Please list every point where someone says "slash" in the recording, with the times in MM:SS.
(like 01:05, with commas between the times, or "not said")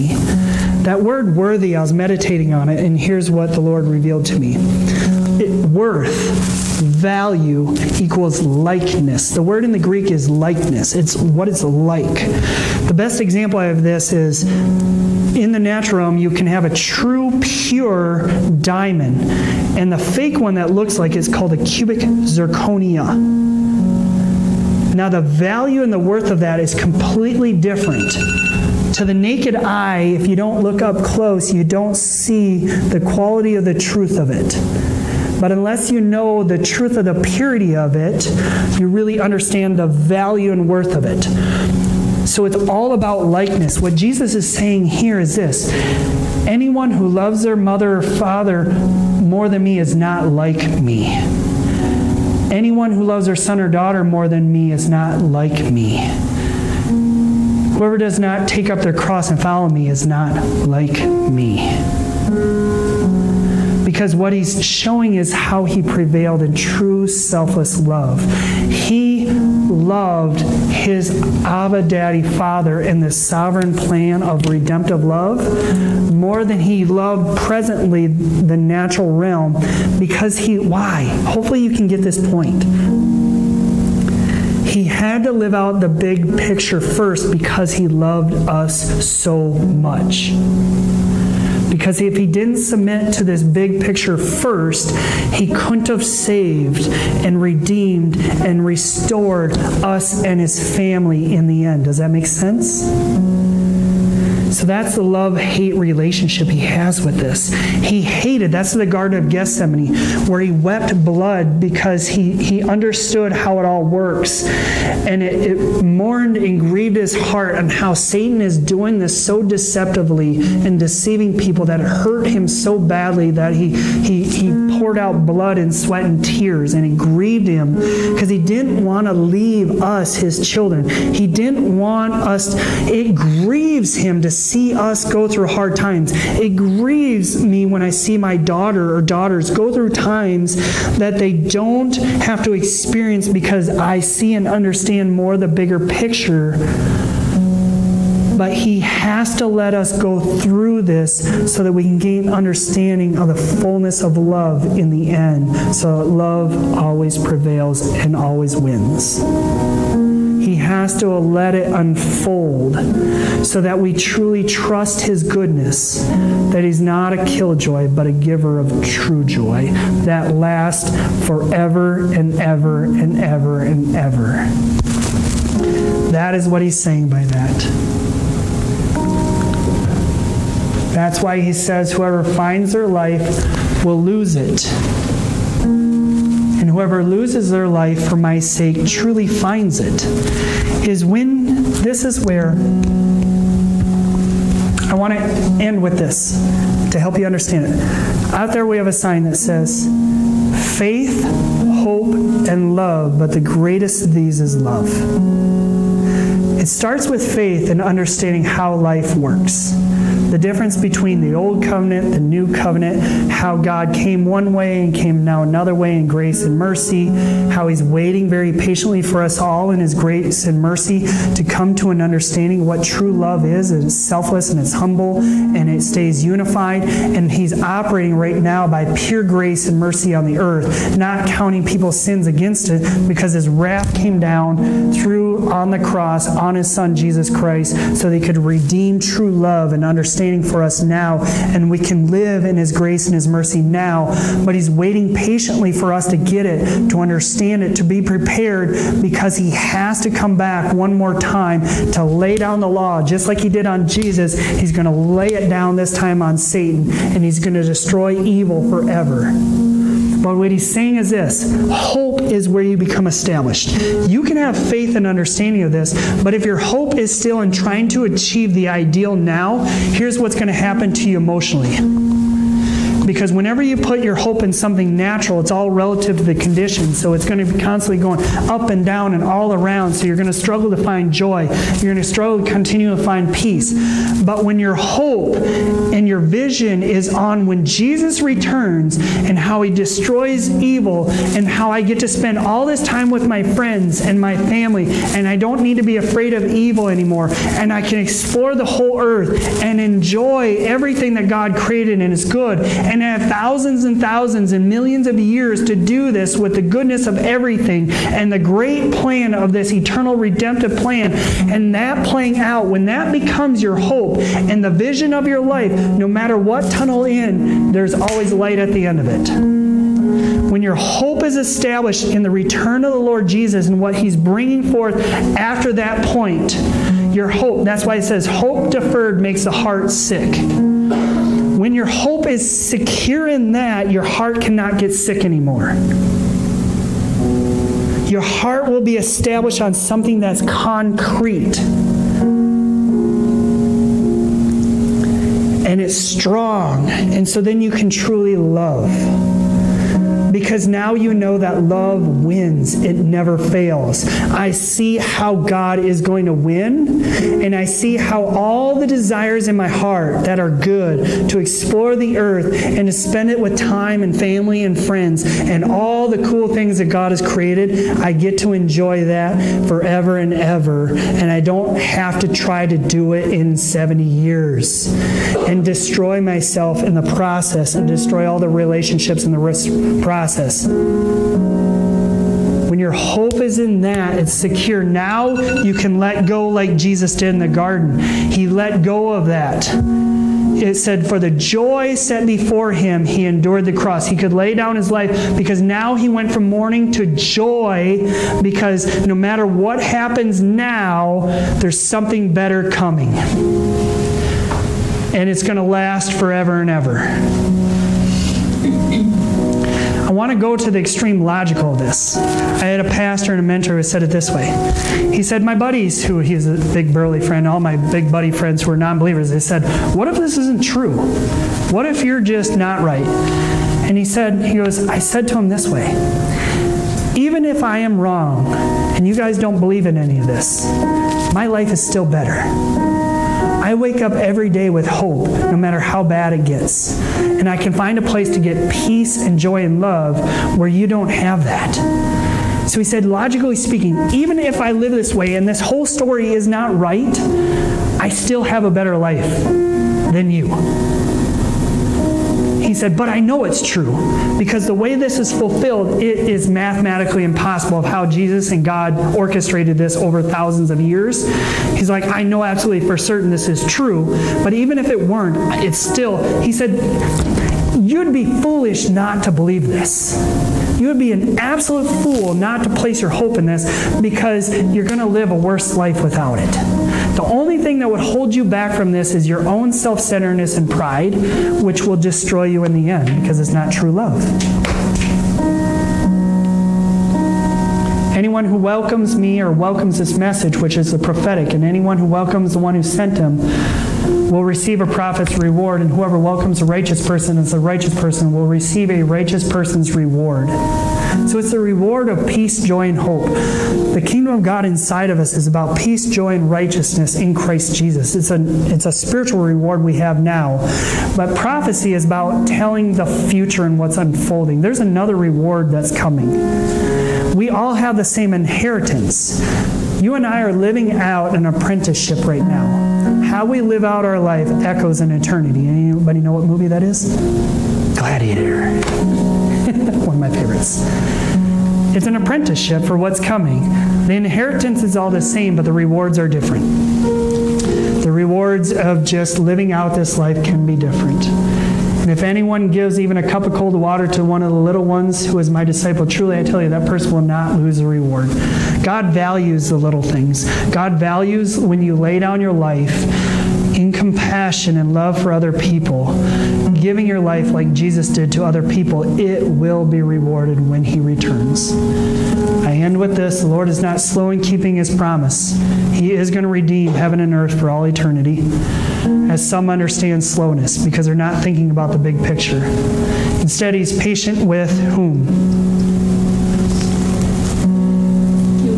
not said.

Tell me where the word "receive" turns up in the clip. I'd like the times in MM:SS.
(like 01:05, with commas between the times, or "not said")
08:14, 08:18.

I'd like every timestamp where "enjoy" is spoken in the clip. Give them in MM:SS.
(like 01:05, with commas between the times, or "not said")
04:59, 06:08.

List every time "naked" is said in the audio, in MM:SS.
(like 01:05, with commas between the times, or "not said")
00:29.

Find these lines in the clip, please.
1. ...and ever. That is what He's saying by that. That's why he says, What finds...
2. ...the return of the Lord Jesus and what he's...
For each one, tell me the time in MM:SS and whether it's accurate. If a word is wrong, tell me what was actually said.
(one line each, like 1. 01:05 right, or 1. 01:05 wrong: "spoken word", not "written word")
1. 02:53 wrong: "Whoever", not "What"
2. 05:22 right.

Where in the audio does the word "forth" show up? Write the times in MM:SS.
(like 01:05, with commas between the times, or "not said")
05:24.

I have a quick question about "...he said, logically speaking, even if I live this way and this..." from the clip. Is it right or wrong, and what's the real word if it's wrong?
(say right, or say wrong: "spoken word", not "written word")
right.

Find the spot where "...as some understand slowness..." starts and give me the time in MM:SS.
09:29.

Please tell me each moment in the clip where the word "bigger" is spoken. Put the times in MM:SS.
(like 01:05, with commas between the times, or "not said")
02:25.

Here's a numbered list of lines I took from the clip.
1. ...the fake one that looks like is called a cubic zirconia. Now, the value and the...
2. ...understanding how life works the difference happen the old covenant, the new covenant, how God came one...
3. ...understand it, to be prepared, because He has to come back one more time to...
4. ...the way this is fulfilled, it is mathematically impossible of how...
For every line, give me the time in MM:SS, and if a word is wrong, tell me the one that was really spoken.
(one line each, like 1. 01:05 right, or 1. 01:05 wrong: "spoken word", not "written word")
1. 00:19 right
2. 03:27 wrong: "between", not "happen"
3. 04:07 right
4. 07:34 right.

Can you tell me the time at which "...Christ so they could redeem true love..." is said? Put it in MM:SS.
03:57.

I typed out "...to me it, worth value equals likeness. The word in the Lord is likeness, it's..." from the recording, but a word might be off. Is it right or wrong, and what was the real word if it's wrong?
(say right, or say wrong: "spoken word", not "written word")
wrong: "Greek", not "Lord".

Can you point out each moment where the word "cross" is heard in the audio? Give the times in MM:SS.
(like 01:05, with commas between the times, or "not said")
00:58, 03:55, 06:33.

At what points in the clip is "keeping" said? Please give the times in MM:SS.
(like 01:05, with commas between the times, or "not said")
09:24.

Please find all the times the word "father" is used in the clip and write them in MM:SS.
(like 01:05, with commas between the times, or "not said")
00:48, 01:12.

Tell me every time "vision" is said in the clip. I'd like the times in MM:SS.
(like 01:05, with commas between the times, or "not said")
04:46, 05:14.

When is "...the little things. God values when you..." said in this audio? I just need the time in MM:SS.
09:09.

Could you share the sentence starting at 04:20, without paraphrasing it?
But what he's saying is this hope is where you become established.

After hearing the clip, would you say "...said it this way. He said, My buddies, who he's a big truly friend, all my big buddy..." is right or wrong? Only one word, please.
wrong.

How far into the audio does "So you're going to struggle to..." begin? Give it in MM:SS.
04:39.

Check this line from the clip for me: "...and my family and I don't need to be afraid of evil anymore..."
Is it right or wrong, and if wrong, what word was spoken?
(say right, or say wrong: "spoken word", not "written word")
right.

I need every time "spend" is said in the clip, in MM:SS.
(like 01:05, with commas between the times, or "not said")
04:52, 06:02.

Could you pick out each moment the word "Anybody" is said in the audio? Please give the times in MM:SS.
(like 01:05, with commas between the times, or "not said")
08:45.